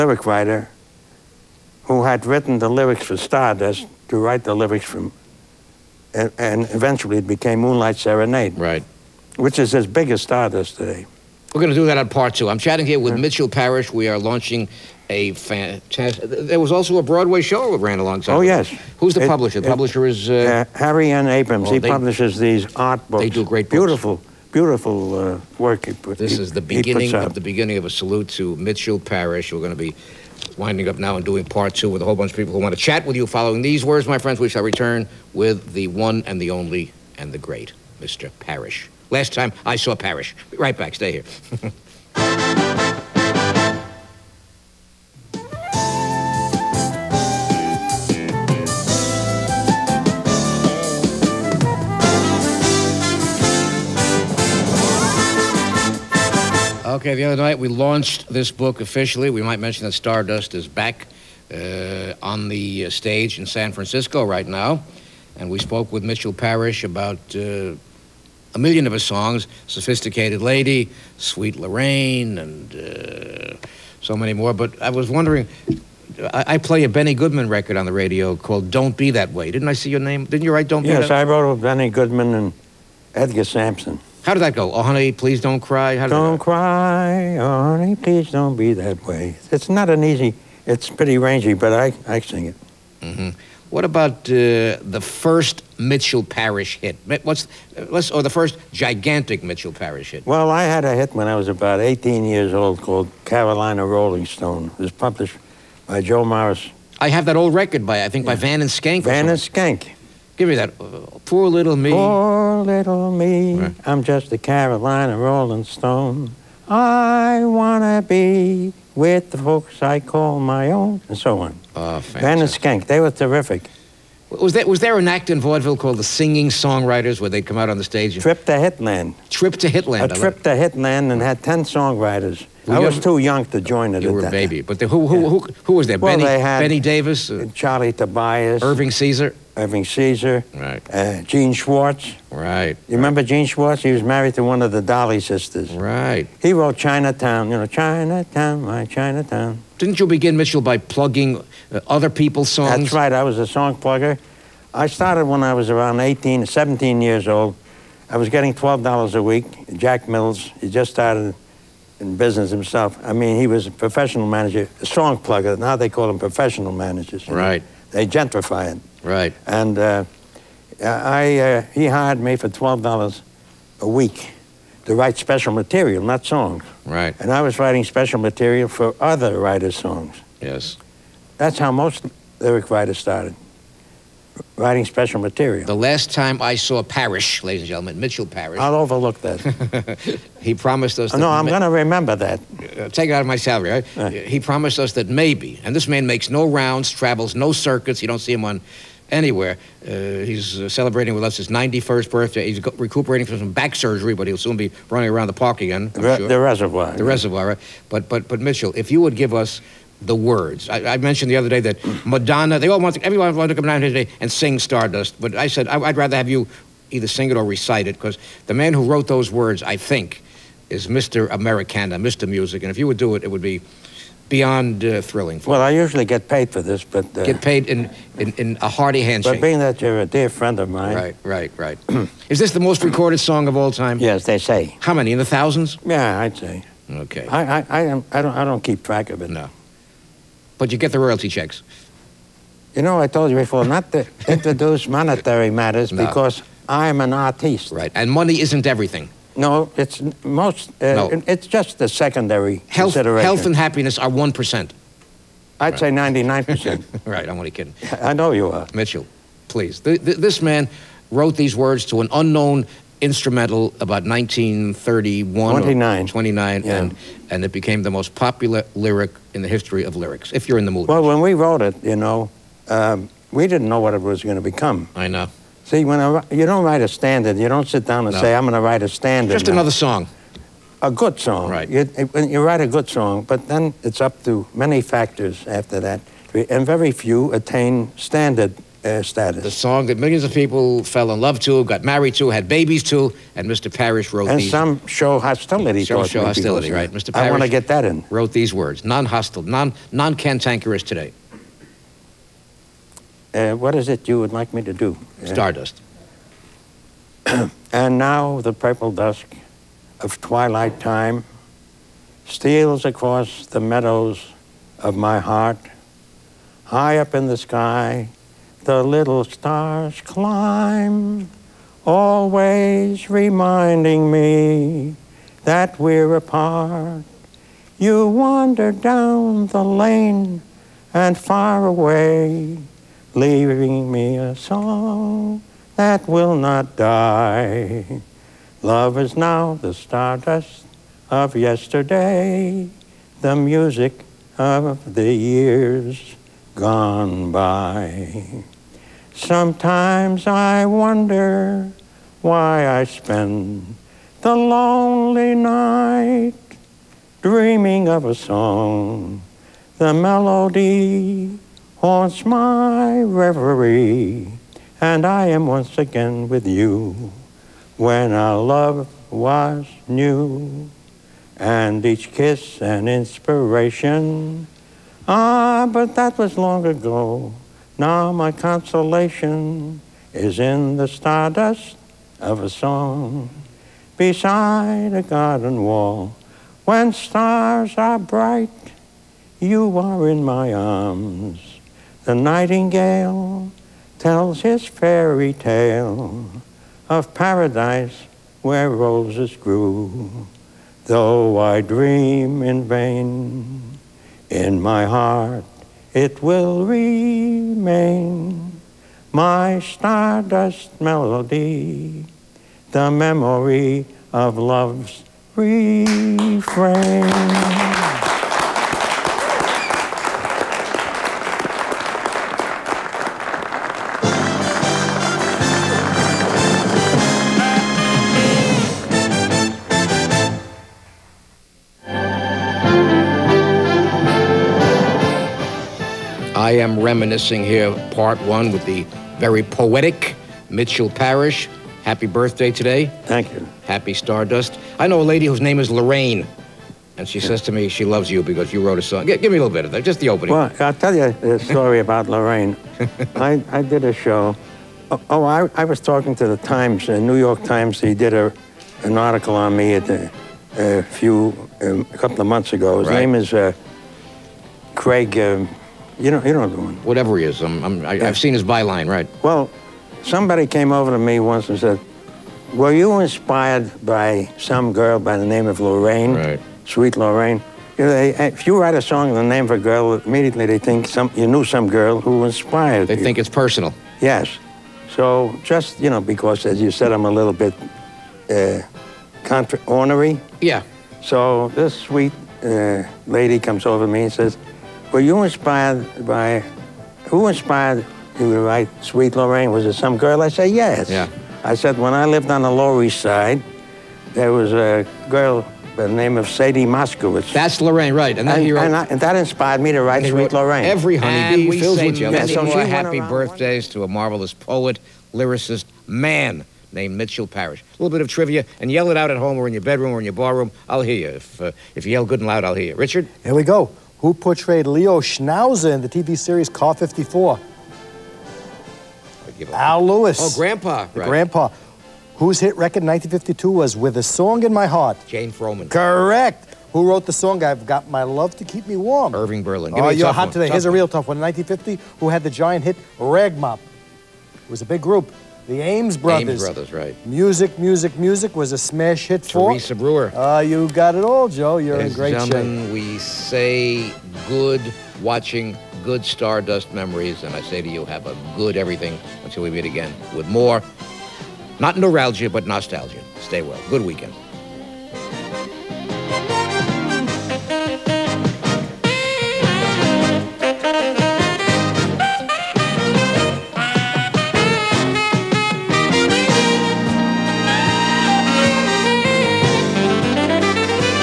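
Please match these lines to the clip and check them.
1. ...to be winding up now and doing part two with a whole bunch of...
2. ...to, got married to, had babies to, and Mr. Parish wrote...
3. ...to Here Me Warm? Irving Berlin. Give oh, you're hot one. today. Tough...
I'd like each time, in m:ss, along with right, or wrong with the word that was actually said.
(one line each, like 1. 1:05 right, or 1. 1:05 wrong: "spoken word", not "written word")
1. 0:29 right
2. 4:51 right
3. 8:58 wrong: "Keep", not "Here".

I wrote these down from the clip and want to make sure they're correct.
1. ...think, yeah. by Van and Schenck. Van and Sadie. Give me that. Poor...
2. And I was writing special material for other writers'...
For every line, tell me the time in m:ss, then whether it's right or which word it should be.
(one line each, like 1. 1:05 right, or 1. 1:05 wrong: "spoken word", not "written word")
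1. 1:48 wrong: "Schenck", not "Sadie"
2. 2:57 right.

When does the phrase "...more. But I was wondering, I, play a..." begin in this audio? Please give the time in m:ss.
1:14.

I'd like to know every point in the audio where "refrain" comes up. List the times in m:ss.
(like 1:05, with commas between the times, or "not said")
6:55.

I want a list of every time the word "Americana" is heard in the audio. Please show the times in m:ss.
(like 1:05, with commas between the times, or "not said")
3:41.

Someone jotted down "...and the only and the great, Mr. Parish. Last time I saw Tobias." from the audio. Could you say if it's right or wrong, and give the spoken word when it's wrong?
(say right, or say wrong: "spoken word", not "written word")
wrong: "Parish", not "Tobias".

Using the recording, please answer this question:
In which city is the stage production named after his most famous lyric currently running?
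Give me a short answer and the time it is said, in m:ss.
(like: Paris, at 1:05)
San Francisco, at 1:03.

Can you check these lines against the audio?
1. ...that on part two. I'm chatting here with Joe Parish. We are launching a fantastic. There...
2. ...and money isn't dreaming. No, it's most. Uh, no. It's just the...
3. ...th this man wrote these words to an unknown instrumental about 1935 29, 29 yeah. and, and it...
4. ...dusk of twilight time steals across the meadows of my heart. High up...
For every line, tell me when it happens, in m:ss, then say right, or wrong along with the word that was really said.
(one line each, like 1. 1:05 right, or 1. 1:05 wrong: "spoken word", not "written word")
1. 0:11 wrong: "Mitchell", not "Joe"
2. 4:07 wrong: "everything", not "dreaming"
3. 4:20 wrong: "1931", not "1935"
4. 5:08 right.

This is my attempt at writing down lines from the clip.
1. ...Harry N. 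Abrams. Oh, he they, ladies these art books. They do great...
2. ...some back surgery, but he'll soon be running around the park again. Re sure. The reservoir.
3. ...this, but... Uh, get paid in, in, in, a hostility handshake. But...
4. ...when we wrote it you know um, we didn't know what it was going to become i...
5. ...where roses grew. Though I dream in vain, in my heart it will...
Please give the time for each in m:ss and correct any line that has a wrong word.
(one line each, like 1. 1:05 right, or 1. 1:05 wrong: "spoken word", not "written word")
1. 0:20 wrong: "publishes", not "ladies"
2. 3:23 right
3. 3:46 wrong: "hearty", not "hostility"
4. 4:31 right
5. 6:38 right.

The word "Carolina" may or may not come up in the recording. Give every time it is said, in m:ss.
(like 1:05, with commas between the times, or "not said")
1:43, 1:54.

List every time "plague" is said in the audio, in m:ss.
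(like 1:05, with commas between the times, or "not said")
not said.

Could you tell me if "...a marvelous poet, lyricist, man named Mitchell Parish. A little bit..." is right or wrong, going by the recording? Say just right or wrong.
right.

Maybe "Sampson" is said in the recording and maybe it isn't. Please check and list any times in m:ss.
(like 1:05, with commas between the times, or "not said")
1:23.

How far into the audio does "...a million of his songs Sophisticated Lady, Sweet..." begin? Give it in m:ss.
1:08.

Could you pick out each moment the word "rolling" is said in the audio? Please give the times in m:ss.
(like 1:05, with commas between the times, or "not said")
1:43, 1:55.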